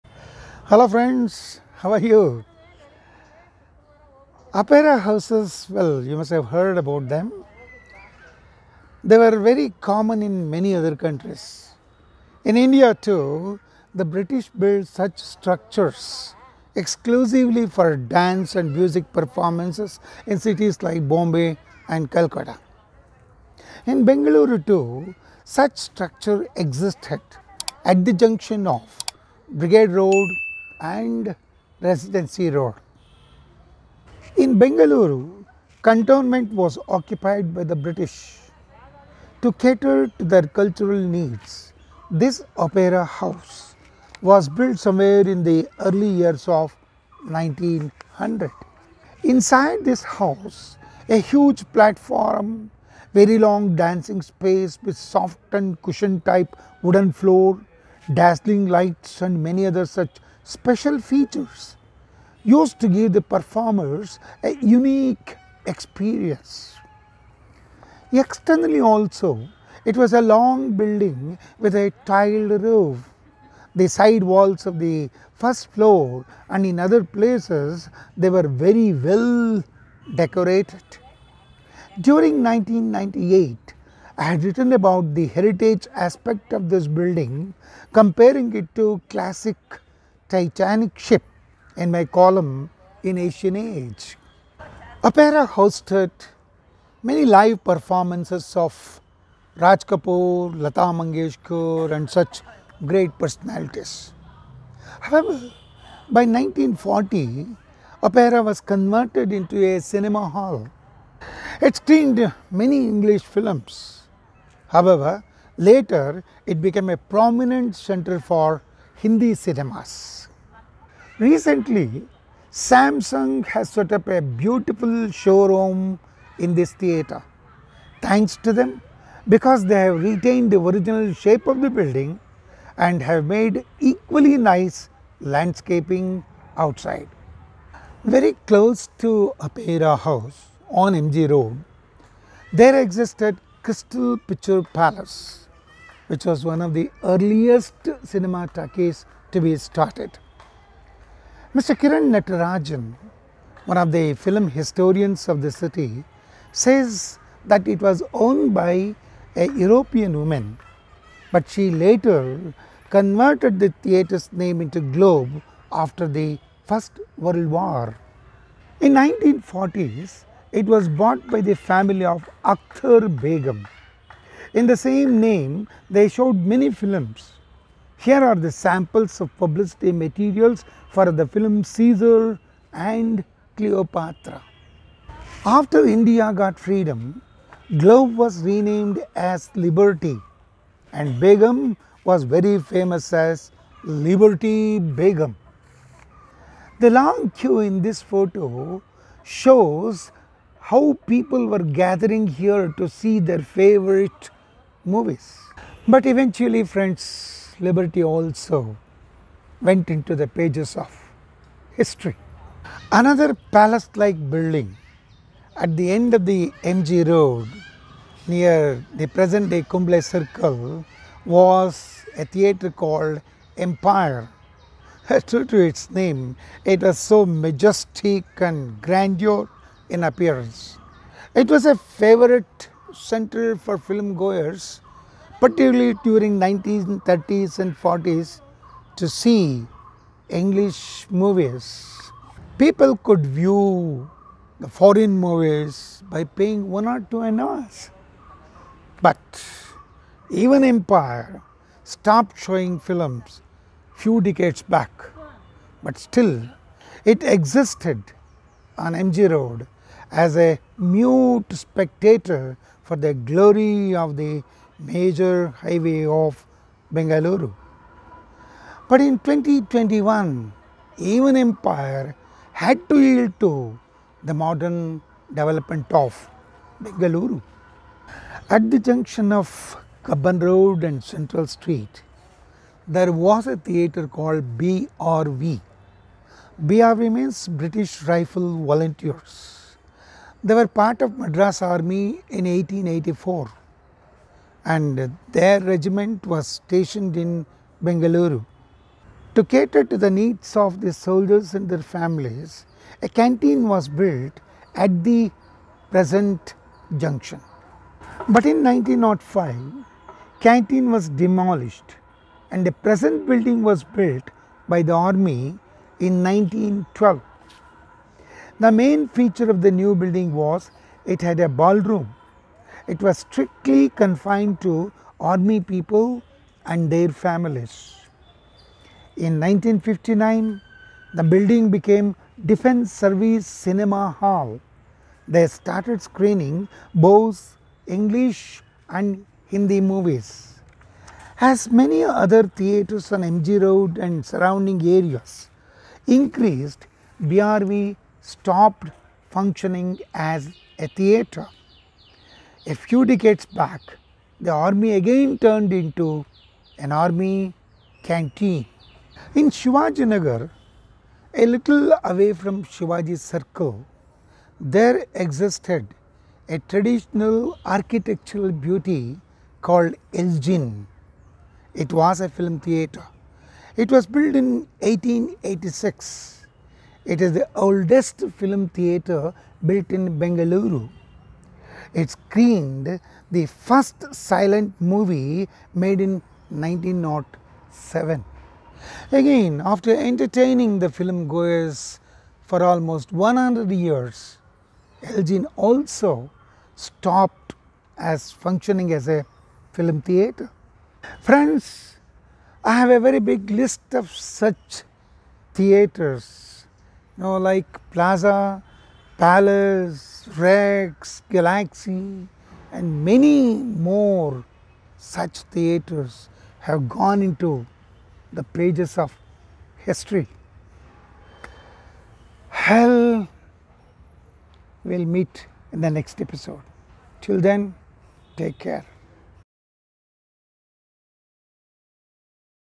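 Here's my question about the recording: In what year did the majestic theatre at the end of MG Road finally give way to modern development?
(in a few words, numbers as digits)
2021.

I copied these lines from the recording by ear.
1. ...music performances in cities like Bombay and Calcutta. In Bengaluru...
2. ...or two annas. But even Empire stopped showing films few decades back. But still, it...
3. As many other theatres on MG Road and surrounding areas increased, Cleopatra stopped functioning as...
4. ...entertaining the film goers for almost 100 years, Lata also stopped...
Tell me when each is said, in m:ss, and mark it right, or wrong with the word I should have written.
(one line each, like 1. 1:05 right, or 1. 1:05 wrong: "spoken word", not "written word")
1. 0:18 right
2. 4:06 right
3. 5:41 wrong: "BRV", not "Cleopatra"
4. 6:29 wrong: "Elgin", not "Lata".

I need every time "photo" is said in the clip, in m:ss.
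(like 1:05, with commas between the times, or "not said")
3:18.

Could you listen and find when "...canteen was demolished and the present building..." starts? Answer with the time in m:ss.
5:10.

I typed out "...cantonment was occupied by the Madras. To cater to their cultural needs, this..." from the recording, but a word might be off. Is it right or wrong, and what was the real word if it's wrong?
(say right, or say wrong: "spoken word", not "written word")
wrong: "British", not "Madras".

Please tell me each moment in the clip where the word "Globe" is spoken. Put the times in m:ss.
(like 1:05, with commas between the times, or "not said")
2:44, 3:07.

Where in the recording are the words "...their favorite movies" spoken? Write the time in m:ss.
3:23.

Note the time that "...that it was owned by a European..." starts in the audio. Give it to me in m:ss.
2:37.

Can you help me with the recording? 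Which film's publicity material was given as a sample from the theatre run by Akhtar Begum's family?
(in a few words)
Caesar and Cleopatra.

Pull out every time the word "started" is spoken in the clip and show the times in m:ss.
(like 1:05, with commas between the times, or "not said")
2:29, 5:35.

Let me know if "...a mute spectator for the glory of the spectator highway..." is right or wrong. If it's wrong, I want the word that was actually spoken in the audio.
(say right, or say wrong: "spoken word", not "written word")
wrong: "major", not "spectator".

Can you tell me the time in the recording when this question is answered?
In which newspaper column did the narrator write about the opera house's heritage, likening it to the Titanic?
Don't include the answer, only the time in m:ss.
1:33.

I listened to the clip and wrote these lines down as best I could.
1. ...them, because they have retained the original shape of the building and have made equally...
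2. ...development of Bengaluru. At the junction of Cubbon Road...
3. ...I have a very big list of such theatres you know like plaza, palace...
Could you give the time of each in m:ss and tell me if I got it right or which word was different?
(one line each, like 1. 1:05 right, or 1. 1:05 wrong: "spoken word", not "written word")
1. 2:08 right
2. 4:35 right
3. 6:42 right.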